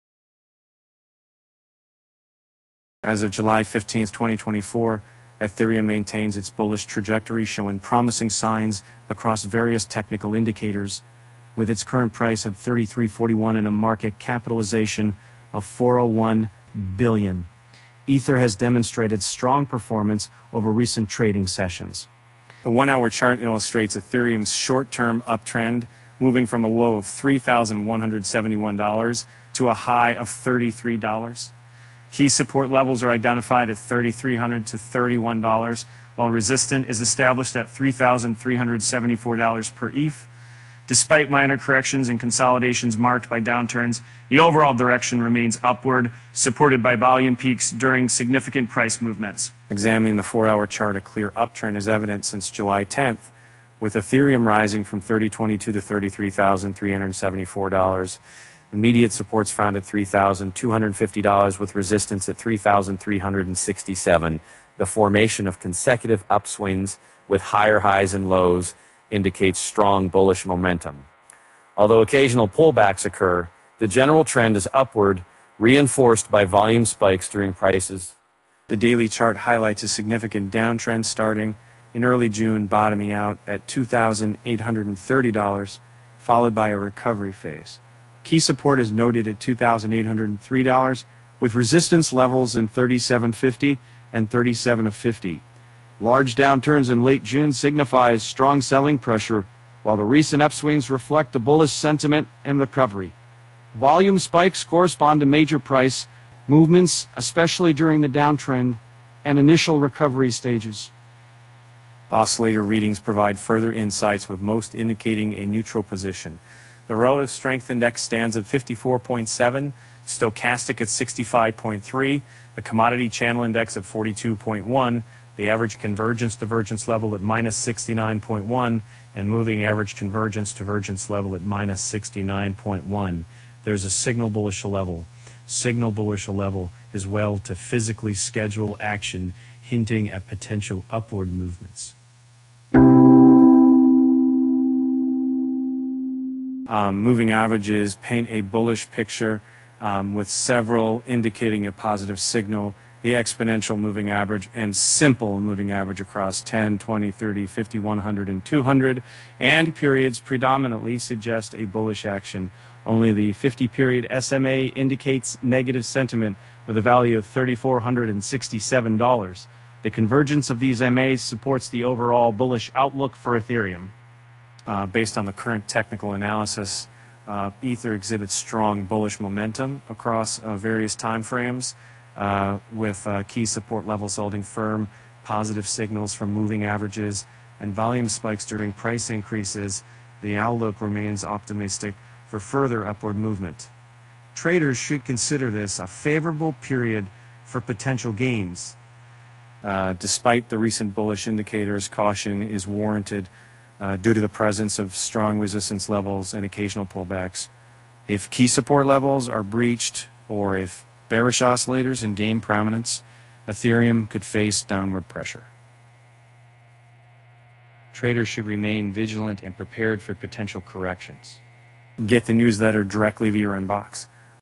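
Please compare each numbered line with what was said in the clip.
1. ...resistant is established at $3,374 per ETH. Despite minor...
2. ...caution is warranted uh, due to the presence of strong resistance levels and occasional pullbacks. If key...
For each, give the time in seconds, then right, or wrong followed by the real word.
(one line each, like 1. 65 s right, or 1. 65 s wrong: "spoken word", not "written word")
1. 36 s right
2. 201 s right.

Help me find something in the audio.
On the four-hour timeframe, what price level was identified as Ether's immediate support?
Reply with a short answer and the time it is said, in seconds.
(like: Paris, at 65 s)
$3,250, at 59 s.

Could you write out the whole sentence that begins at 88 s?
Key support is noted at $2,803, with resistance levels in 37.50 and 37.50.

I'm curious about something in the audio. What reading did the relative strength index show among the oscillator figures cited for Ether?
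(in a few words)
54.7.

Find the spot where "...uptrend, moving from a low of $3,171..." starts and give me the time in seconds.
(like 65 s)
25 s.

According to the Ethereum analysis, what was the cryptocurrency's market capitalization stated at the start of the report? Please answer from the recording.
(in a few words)
401 billion.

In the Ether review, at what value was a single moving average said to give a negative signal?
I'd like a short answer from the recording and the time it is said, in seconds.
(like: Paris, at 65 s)
$3,467, at 167 s.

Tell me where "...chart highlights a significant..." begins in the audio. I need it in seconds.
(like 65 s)
79 s.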